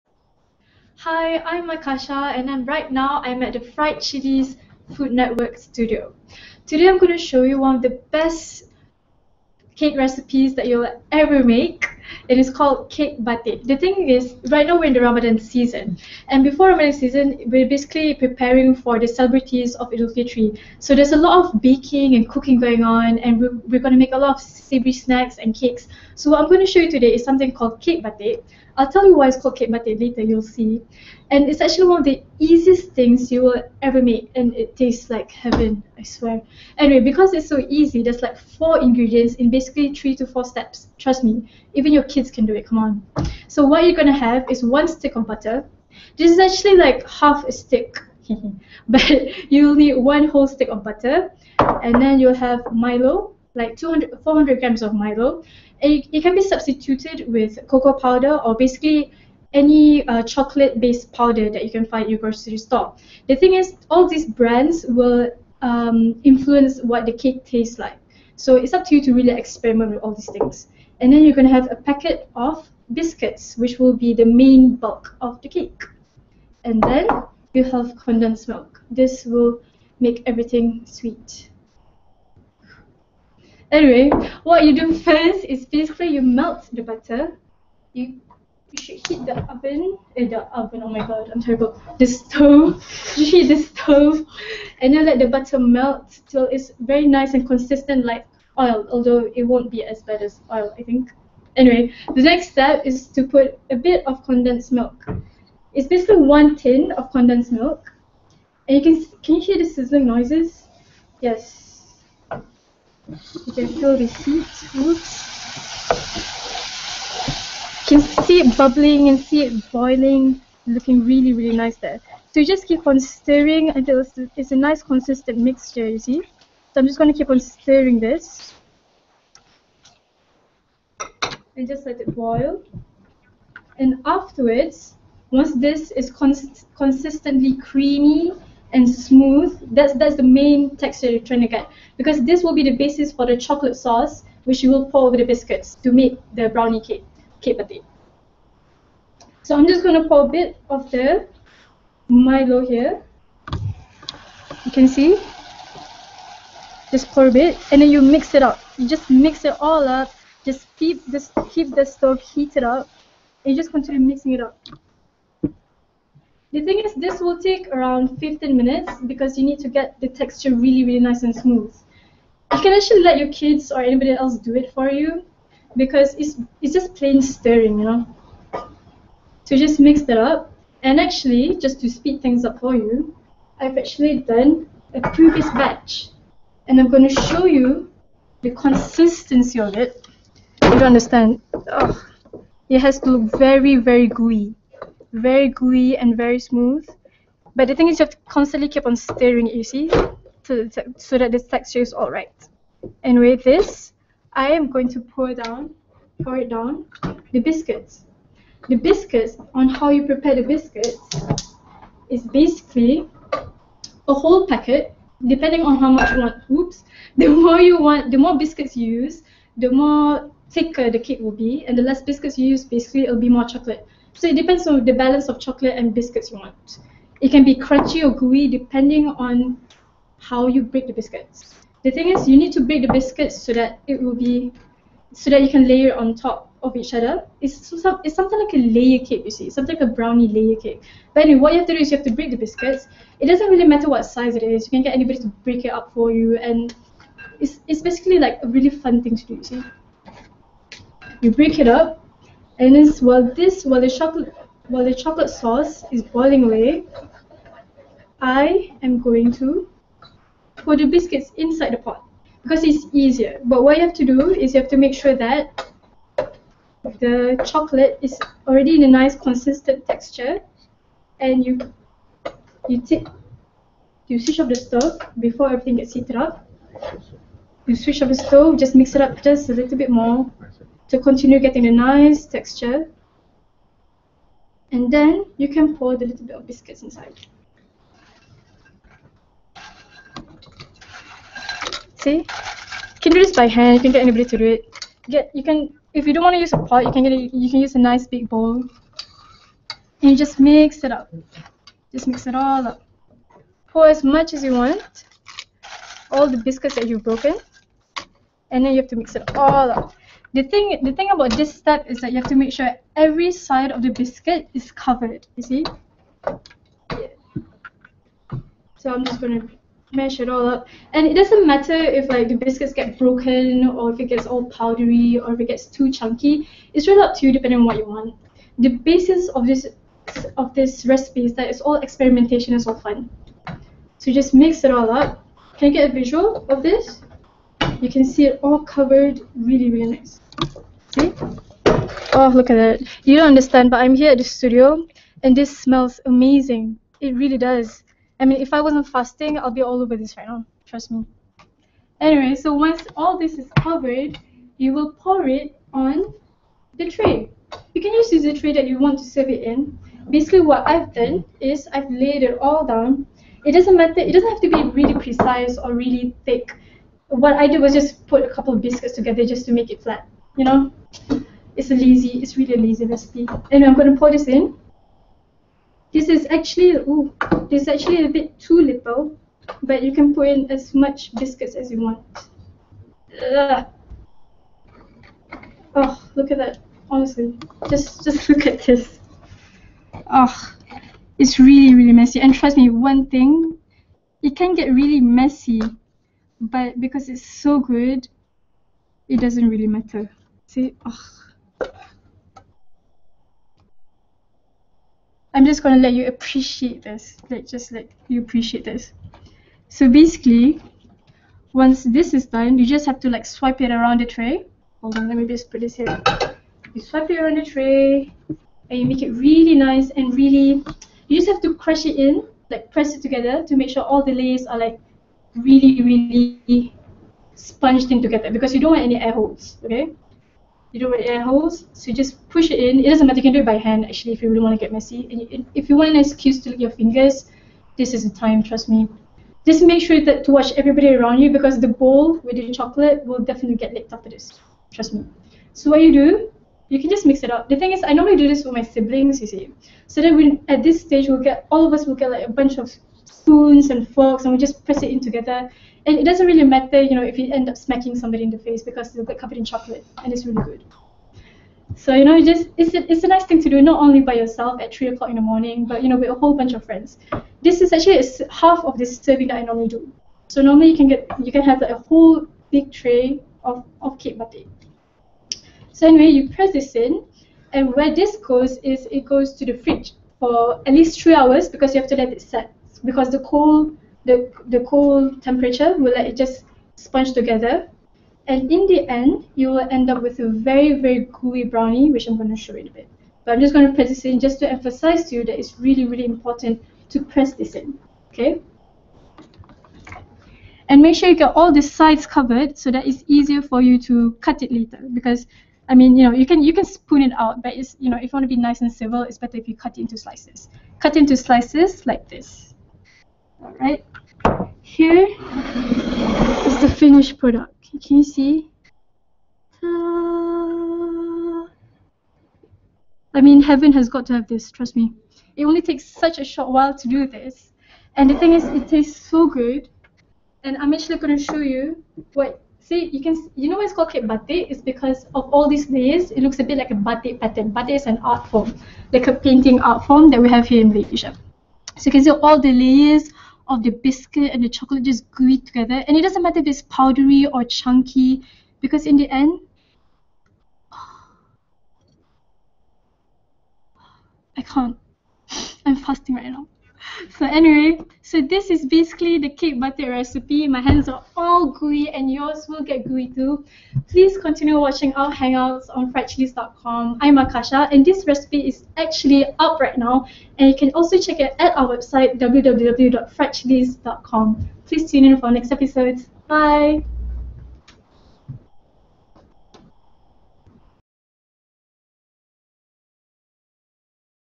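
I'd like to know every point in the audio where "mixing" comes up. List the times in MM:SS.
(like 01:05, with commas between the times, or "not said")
02:44.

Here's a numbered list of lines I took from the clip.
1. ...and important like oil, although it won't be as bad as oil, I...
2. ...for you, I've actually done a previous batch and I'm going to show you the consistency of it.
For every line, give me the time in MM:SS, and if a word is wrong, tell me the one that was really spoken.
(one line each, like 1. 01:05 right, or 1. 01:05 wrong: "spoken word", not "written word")
1. 01:37 wrong: "consistent", not "important"
2. 03:02 right.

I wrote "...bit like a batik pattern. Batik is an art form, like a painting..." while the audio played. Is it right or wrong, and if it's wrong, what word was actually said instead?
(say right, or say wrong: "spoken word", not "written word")
right.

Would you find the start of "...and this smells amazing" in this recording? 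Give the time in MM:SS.
05:45.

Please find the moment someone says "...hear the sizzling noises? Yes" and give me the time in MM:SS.
01:49.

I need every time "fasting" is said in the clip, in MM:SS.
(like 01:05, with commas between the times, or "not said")
05:48, 09:15.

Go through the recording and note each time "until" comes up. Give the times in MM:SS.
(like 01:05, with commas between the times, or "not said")
02:03.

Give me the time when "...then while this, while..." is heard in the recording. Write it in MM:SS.
04:12.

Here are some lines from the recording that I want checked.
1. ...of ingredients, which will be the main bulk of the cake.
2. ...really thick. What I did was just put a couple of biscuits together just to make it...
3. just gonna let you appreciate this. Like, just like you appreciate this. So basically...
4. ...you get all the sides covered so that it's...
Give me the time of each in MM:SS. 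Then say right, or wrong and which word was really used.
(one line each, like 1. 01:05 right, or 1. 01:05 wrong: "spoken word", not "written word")
1. 01:12 wrong: "biscuits", not "ingredients"
2. 06:05 right
3. 06:45 right
4. 08:21 right.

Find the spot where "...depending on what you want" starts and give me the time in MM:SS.
05:27.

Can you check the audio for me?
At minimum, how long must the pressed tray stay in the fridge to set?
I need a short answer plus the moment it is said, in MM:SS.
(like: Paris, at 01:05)
3 hours, at 08:00.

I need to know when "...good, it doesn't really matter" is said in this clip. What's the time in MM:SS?
06:37.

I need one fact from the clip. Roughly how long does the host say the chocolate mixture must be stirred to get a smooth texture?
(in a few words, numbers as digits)
15 minutes.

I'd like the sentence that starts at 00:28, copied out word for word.
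I'll tell you why it's called cake batik later, you'll see.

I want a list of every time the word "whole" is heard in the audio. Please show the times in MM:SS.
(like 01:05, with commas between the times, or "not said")
00:50, 03:34, 07:46, 07:51.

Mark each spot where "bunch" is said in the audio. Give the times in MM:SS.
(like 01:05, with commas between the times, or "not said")
07:32, 07:46.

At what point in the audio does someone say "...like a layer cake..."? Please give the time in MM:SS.
03:58.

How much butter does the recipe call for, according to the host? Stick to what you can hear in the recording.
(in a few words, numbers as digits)
One stick.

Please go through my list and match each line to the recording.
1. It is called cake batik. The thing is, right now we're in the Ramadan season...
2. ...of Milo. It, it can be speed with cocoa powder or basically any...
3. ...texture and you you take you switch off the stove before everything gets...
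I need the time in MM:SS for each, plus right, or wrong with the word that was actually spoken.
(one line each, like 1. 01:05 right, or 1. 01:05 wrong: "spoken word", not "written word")
1. 00:12 right
2. 00:54 wrong: "substituted", not "speed"
3. 04:29 right.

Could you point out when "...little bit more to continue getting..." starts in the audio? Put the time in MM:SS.
04:39.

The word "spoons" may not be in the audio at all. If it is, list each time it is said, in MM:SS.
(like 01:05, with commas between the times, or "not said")
07:33, 08:26.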